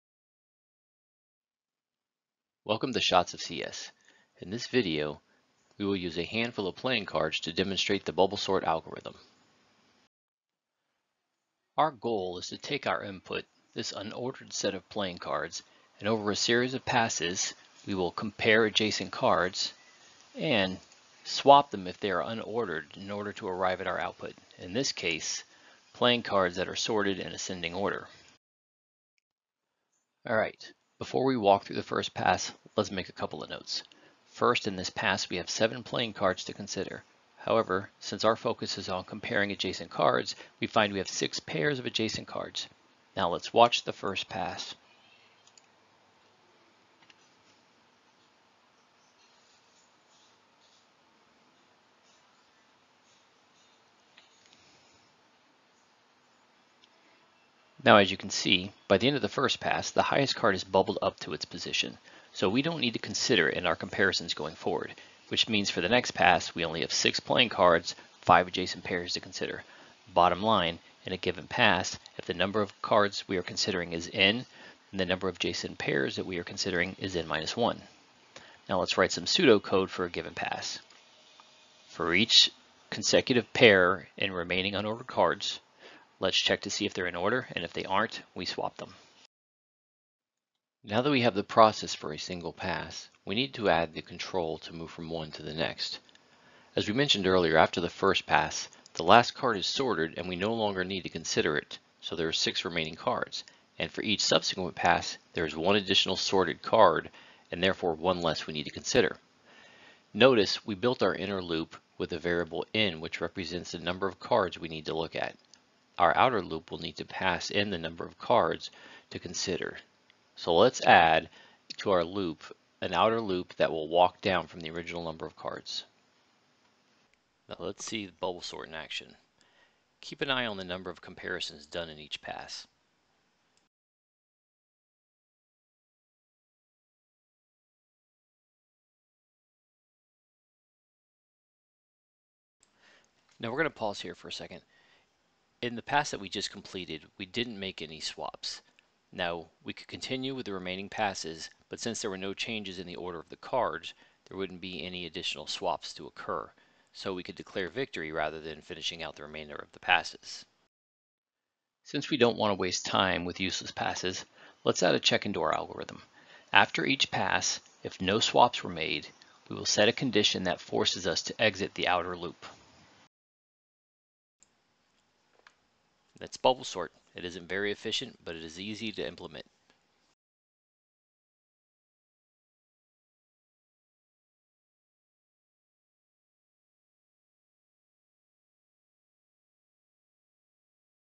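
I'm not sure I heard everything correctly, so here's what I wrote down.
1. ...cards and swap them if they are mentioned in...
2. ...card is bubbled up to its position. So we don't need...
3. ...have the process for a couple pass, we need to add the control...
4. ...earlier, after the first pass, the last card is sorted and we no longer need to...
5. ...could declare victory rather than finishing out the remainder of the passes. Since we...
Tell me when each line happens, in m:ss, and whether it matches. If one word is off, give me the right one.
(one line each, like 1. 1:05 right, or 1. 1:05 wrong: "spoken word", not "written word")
1. 0:19 wrong: "unordered", not "mentioned"
2. 1:00 right
3. 1:31 wrong: "single", not "couple"
4. 1:37 right
5. 2:37 right.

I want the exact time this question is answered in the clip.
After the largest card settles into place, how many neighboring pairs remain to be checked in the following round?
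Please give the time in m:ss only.
1:08.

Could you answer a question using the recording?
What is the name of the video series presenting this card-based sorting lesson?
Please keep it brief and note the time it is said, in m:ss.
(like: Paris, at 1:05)
Shots of CS, at 0:03.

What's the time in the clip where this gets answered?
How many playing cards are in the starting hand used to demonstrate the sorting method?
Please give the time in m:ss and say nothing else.
0:35.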